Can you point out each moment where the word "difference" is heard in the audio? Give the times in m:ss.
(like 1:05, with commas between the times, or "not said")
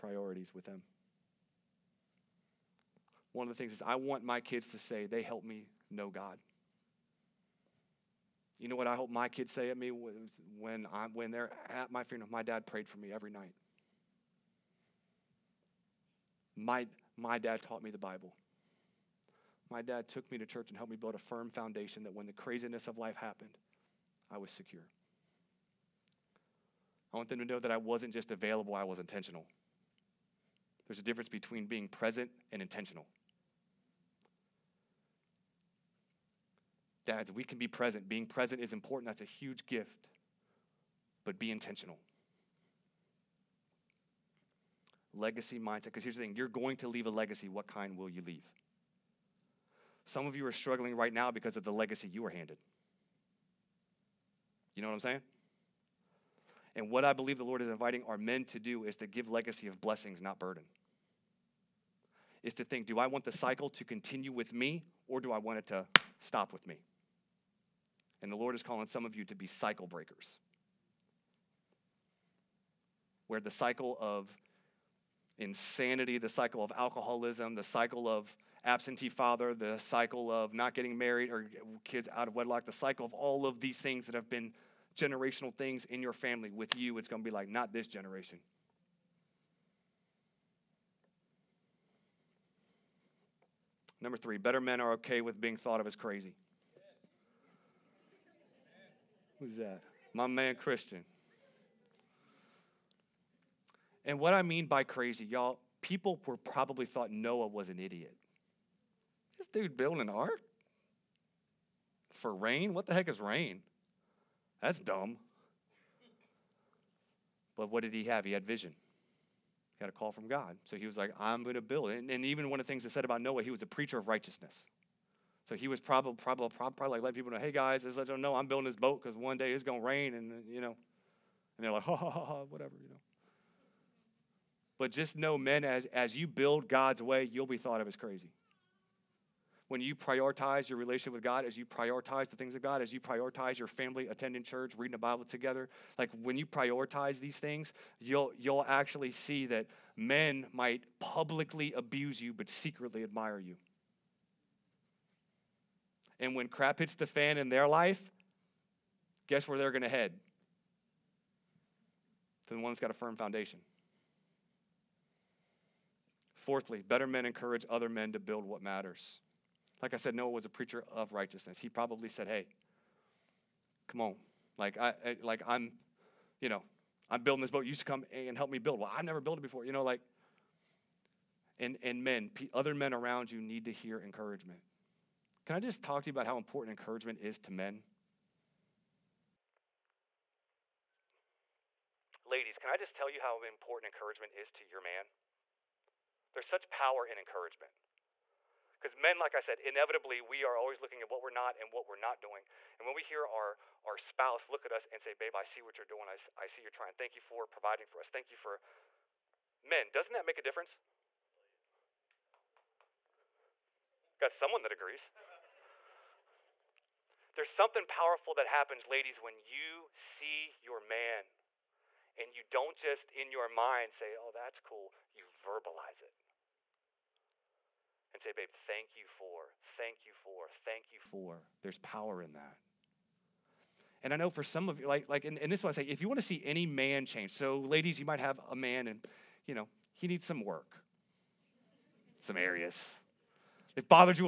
0:31, 3:30.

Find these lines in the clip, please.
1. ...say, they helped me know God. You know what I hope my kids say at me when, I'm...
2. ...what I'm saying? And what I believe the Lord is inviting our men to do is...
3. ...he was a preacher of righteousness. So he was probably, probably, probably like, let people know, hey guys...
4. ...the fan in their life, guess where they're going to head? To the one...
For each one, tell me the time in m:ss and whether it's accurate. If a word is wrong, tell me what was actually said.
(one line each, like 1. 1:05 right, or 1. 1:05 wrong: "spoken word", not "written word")
1. 0:04 right
2. 0:54 right
3. 2:03 right
4. 2:36 right.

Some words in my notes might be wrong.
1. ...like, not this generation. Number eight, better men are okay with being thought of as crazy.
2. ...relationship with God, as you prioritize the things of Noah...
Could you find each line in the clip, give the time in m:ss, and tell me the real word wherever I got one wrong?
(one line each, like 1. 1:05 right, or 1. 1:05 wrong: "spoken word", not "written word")
1. 1:27 wrong: "three", not "eight"
2. 2:20 wrong: "God", not "Noah".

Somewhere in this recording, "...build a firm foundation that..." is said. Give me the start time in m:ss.
0:20.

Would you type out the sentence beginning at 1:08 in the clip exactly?
And the Lord is calling some of you to be cycle breakers.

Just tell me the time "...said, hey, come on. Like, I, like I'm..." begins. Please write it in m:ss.
2:52.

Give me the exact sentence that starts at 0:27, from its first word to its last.
I want them to know that I wasn't just available, I was intentional.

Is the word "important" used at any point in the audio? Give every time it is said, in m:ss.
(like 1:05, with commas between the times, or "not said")
0:38, 3:06, 3:13.